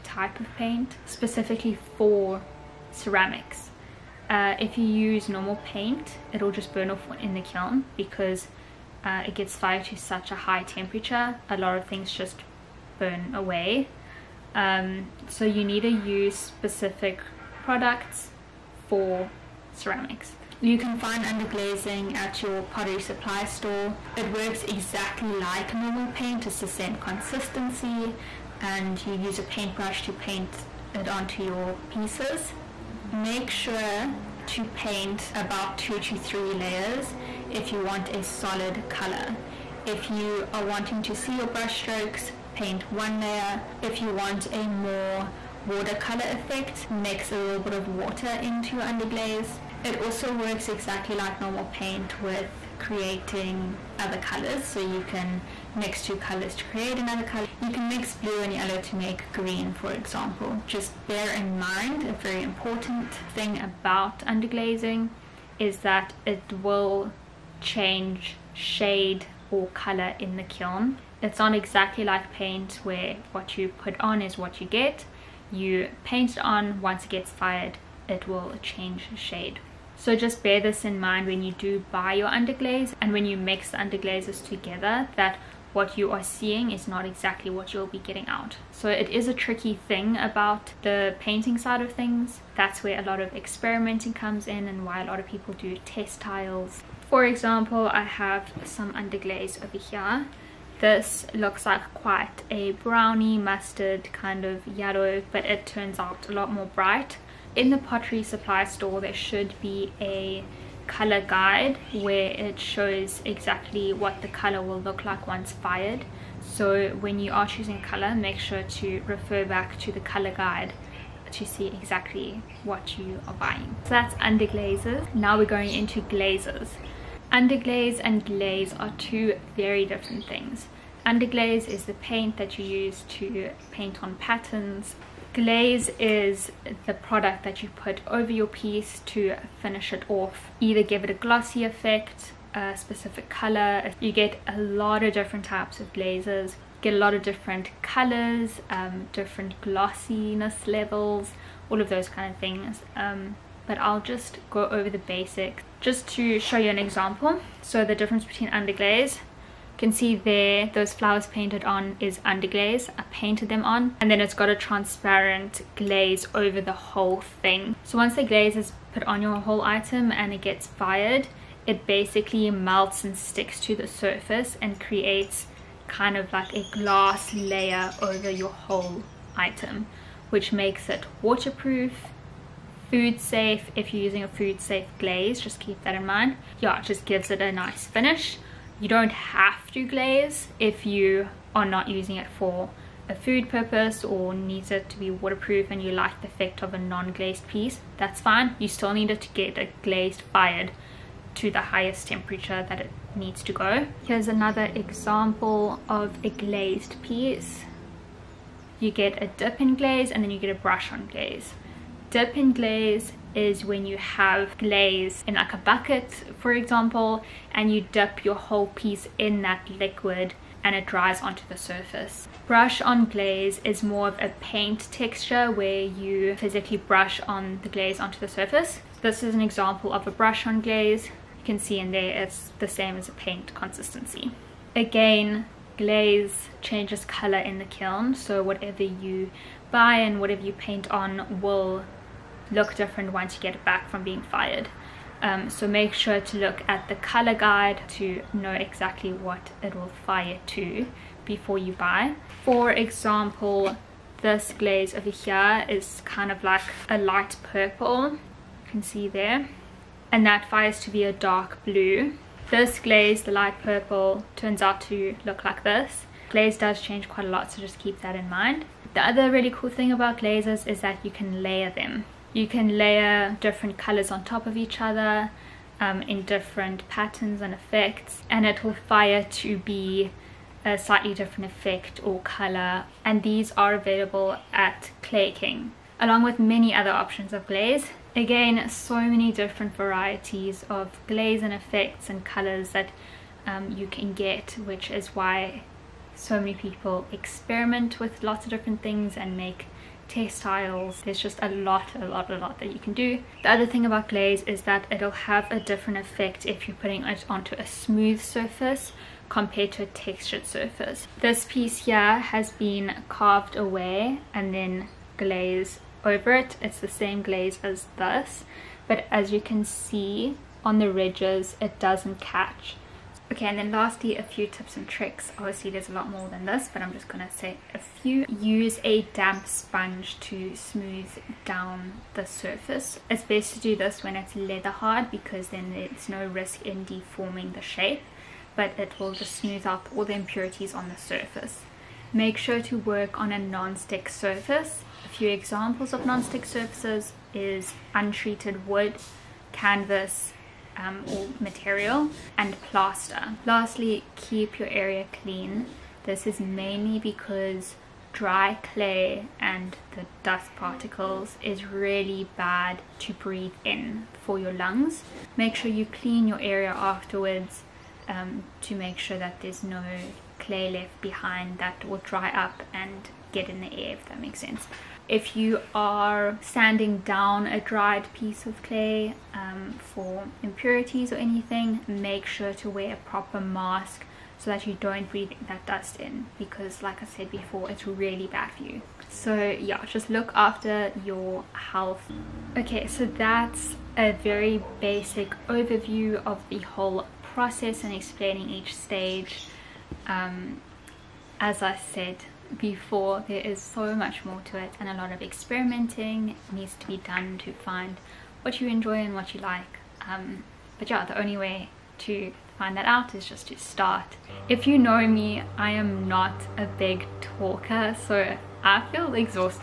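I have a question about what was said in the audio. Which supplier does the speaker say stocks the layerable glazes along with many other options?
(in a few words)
Clay King.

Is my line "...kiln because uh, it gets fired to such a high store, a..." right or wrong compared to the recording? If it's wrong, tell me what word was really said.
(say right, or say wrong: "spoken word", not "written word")
wrong: "temperature", not "store".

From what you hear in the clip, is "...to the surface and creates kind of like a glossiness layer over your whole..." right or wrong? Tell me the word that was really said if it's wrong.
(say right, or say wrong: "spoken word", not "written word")
wrong: "glass", not "glossiness".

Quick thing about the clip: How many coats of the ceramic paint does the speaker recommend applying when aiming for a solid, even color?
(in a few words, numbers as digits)
2 to 3 layers.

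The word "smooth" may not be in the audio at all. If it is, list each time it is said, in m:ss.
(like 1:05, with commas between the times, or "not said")
5:07, 5:30, 5:39.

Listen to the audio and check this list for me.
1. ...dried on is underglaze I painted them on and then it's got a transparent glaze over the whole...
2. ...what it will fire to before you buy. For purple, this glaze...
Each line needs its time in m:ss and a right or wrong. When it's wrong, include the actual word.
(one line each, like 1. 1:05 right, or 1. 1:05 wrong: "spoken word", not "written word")
1. 2:41 wrong: "painted", not "dried"
2. 4:09 wrong: "example", not "purple".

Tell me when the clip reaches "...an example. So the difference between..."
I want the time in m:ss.
2:36.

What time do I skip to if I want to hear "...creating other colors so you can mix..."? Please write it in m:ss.
0:52.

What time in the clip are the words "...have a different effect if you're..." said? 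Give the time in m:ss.
5:05.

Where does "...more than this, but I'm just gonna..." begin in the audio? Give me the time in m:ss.
5:26.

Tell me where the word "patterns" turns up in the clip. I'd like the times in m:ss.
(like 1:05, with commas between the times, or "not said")
2:14, 4:36.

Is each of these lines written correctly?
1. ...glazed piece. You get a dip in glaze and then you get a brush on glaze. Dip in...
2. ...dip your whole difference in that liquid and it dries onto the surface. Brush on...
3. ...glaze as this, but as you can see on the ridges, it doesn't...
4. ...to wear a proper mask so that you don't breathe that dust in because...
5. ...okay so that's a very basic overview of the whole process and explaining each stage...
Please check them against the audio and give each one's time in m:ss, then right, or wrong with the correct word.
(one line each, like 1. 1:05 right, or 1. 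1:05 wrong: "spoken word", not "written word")
1. 3:26 right
2. 3:37 wrong: "piece", not "difference"
3. 5:17 right
4. 6:22 right
5. 6:32 right.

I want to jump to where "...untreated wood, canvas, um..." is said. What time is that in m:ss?
5:47.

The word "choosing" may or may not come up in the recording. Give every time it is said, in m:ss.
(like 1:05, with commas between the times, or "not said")
1:57.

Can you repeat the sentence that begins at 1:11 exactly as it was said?
It's not exactly like paint where what you put on is what you get.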